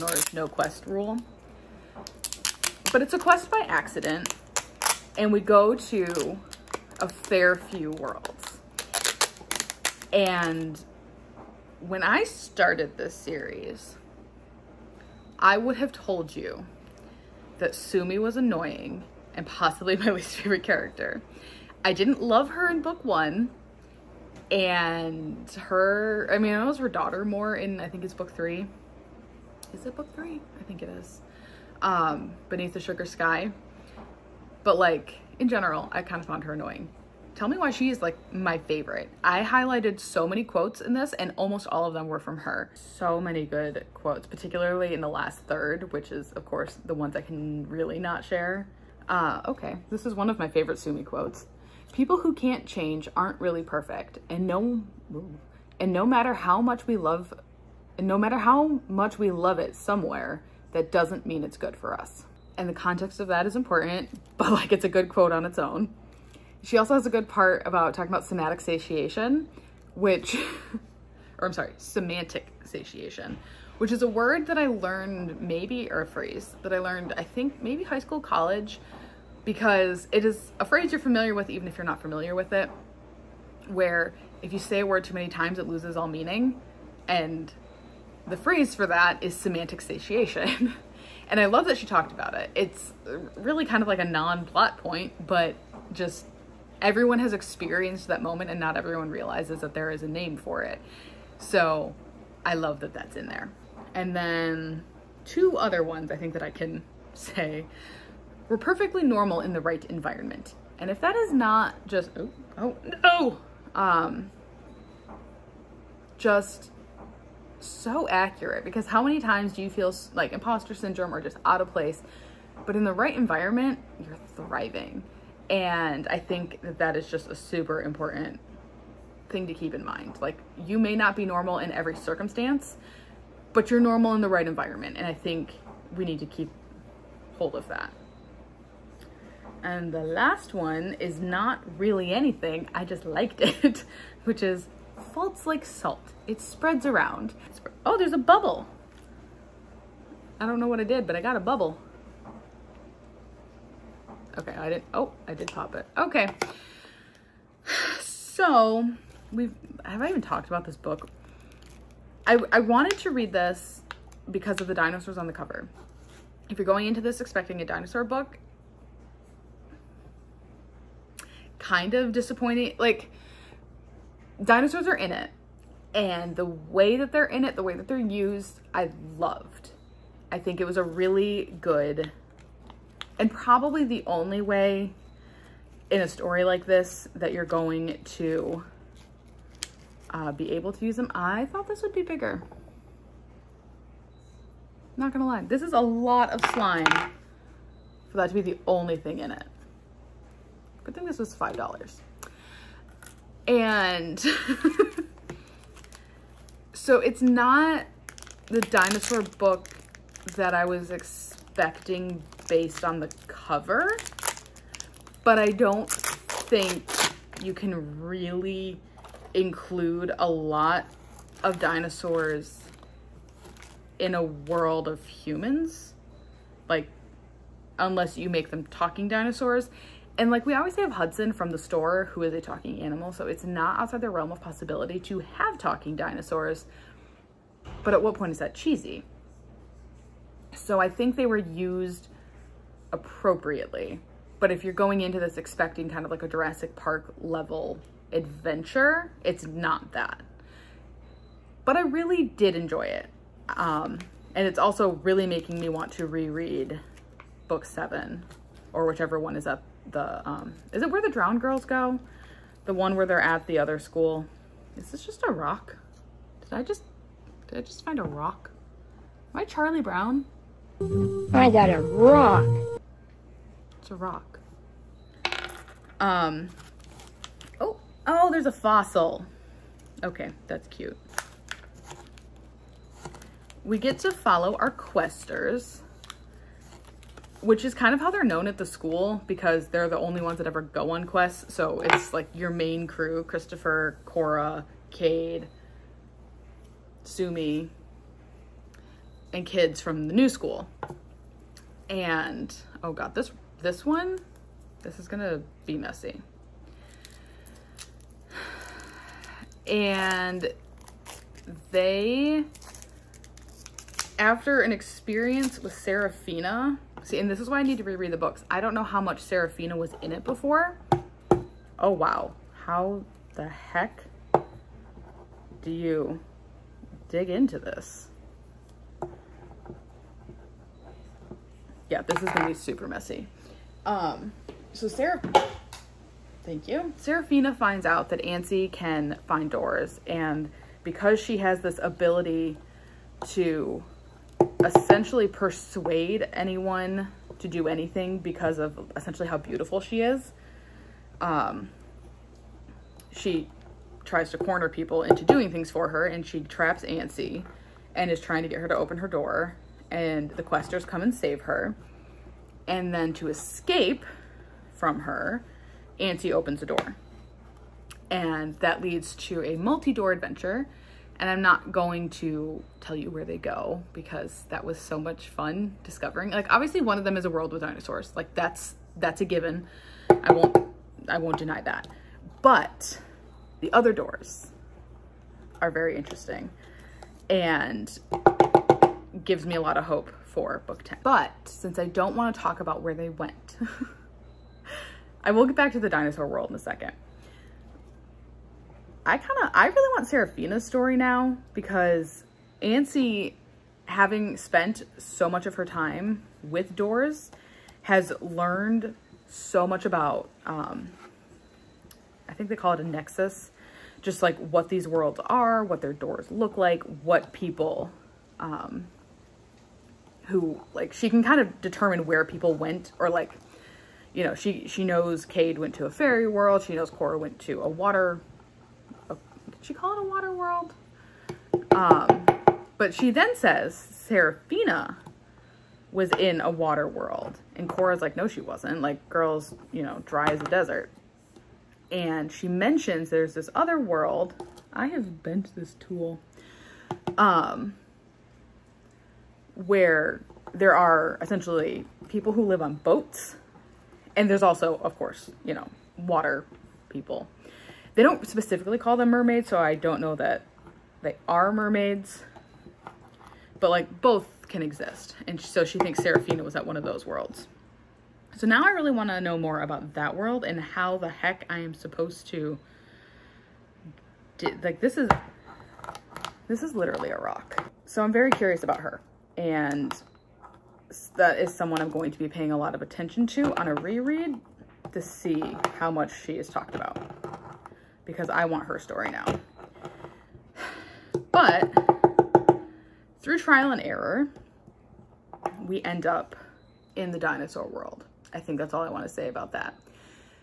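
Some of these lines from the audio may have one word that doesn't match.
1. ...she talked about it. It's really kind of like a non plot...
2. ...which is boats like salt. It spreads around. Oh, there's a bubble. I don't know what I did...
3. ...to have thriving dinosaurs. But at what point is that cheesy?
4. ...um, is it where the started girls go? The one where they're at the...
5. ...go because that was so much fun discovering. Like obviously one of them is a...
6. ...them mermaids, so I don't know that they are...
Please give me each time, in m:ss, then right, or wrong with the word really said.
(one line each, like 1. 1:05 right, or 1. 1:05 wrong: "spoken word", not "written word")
1. 1:31 right
2. 2:24 wrong: "faults", not "boats"
3. 3:55 wrong: "talking", not "thriving"
4. 4:20 wrong: "drowned", not "started"
5. 6:13 right
6. 7:38 right.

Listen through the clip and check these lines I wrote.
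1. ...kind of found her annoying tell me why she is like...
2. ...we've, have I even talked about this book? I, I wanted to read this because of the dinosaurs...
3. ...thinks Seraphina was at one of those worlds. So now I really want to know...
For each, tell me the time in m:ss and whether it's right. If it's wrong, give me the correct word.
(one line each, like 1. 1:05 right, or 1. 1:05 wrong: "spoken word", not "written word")
1. 0:36 right
2. 2:39 right
3. 7:45 right.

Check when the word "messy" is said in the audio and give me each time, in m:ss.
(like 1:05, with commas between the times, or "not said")
5:05, 5:32.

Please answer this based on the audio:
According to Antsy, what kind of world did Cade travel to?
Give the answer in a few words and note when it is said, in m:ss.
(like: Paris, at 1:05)
a fairy world, at 7:05.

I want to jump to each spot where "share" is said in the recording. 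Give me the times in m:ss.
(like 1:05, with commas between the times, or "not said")
0:48.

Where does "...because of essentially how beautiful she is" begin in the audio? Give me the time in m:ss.
5:48.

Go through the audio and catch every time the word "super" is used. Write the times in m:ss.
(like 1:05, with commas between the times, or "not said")
2:07, 5:32.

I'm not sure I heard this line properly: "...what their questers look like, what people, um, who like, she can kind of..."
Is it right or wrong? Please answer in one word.
wrong.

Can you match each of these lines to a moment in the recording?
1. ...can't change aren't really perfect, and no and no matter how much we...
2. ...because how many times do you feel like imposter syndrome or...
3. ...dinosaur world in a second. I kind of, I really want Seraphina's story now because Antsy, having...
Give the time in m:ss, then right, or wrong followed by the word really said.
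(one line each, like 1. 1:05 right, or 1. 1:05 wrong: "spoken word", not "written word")
1. 0:52 right
2. 1:58 right
3. 6:35 right.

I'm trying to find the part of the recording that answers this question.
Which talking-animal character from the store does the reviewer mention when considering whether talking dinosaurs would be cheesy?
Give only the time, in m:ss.
3:50.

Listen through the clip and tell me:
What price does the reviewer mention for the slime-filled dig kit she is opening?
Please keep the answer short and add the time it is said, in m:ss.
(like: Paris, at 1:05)
$5, at 3:21.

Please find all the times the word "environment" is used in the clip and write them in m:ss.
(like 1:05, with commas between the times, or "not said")
1:49, 2:03, 2:14.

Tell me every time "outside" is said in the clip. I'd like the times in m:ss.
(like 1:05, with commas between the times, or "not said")
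3:53.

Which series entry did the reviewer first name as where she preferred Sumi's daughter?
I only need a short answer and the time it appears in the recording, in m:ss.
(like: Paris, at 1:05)
Beneath the Sugar Sky, at 0:32.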